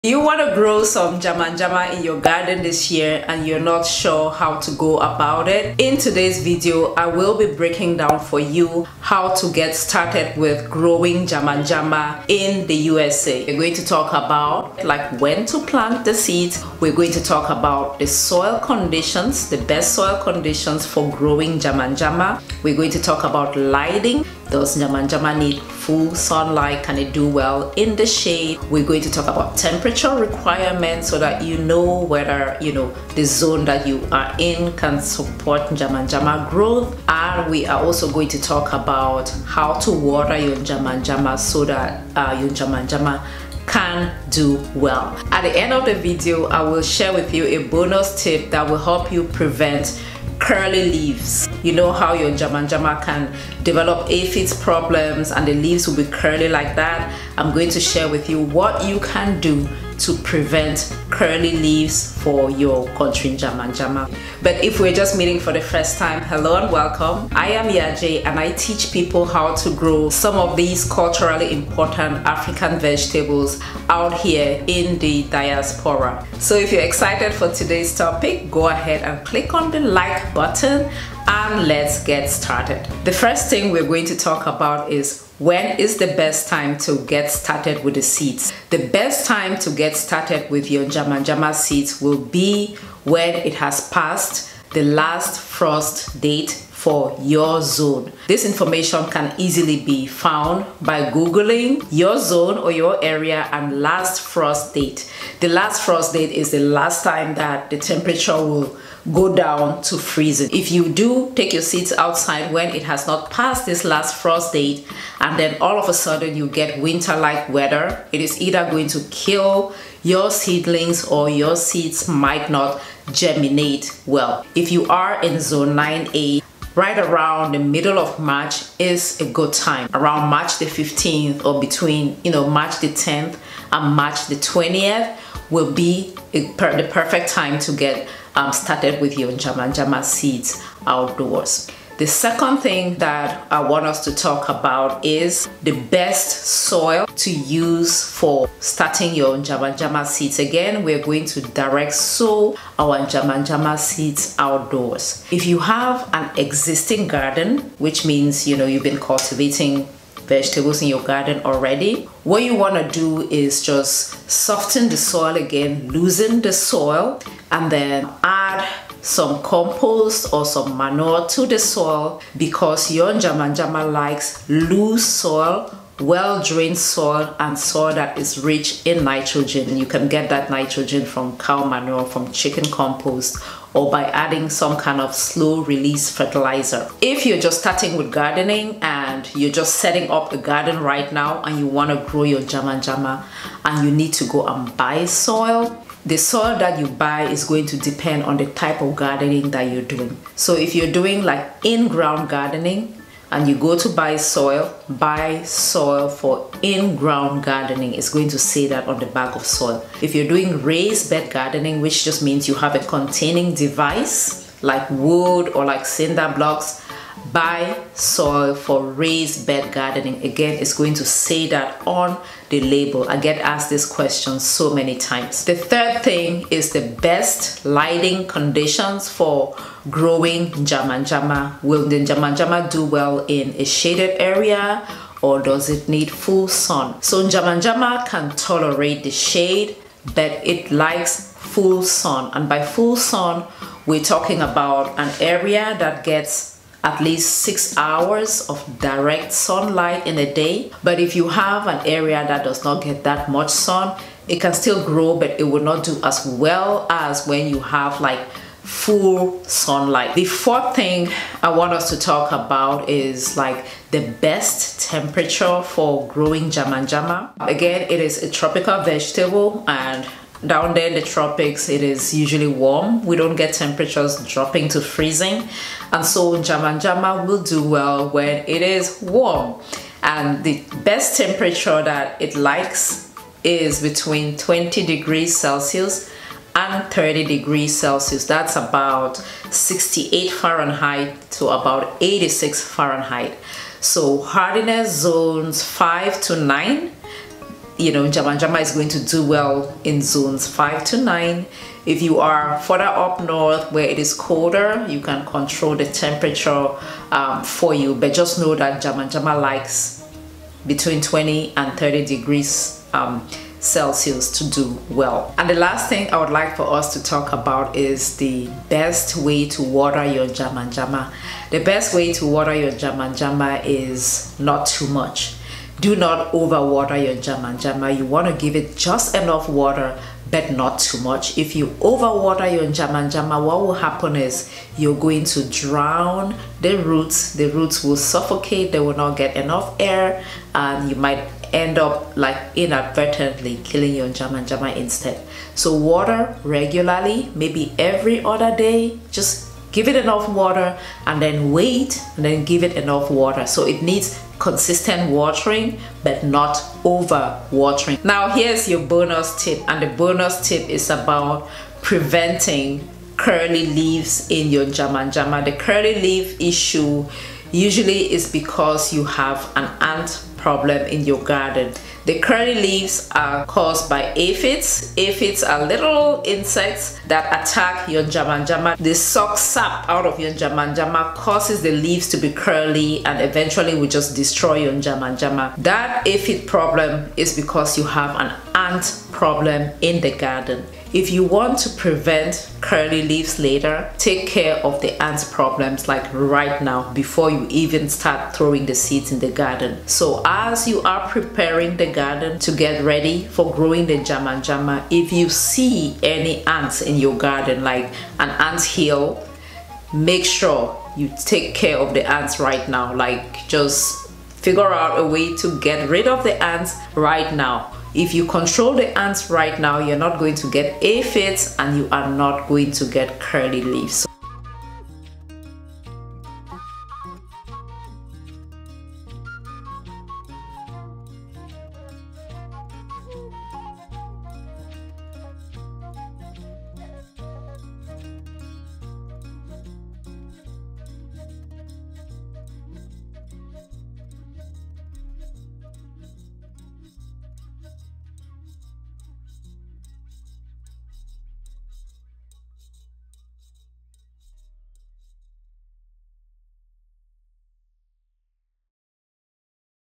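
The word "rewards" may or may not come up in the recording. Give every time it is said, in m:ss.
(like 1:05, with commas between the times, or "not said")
not said.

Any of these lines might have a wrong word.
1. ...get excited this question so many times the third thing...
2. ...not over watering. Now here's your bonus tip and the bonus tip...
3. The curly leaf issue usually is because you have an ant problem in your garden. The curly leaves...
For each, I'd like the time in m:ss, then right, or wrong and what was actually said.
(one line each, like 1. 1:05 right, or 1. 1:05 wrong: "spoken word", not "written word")
1. 3:43 wrong: "asked", not "excited"
2. 5:56 right
3. 6:05 right.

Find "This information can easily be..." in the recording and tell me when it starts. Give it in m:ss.
1:38.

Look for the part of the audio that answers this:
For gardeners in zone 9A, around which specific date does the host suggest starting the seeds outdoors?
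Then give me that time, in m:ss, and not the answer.
2:10.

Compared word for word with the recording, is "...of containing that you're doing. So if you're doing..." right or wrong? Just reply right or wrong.
wrong.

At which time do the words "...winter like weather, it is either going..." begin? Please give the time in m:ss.
1:56.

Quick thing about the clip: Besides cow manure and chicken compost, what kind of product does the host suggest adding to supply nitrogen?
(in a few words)
slow release fertilizer.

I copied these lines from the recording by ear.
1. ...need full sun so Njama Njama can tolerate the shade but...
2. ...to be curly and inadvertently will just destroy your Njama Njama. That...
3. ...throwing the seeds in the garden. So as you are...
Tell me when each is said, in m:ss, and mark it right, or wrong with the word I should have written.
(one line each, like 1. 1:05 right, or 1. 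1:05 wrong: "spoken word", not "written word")
1. 3:55 right
2. 6:22 wrong: "eventually", not "inadvertently"
3. 6:38 right.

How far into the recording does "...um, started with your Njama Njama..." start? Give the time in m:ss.
2:18.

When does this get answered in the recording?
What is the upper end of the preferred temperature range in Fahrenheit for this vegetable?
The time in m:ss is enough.
4:52.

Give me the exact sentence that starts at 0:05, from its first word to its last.
In today's video, I will be breaking down for you how to get started with growing Njama Njama in the USA.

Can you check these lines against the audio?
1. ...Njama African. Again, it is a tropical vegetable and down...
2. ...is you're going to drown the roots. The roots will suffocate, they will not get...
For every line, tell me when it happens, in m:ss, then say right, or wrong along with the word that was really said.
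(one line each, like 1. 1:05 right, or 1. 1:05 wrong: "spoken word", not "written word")
1. 4:26 wrong: "Njama", not "African"
2. 5:34 right.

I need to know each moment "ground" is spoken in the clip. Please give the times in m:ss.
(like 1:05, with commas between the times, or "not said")
3:21, 3:26.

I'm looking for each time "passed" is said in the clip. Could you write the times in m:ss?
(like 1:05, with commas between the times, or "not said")
1:33, 1:53.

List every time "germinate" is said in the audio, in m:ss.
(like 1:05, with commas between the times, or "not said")
2:03.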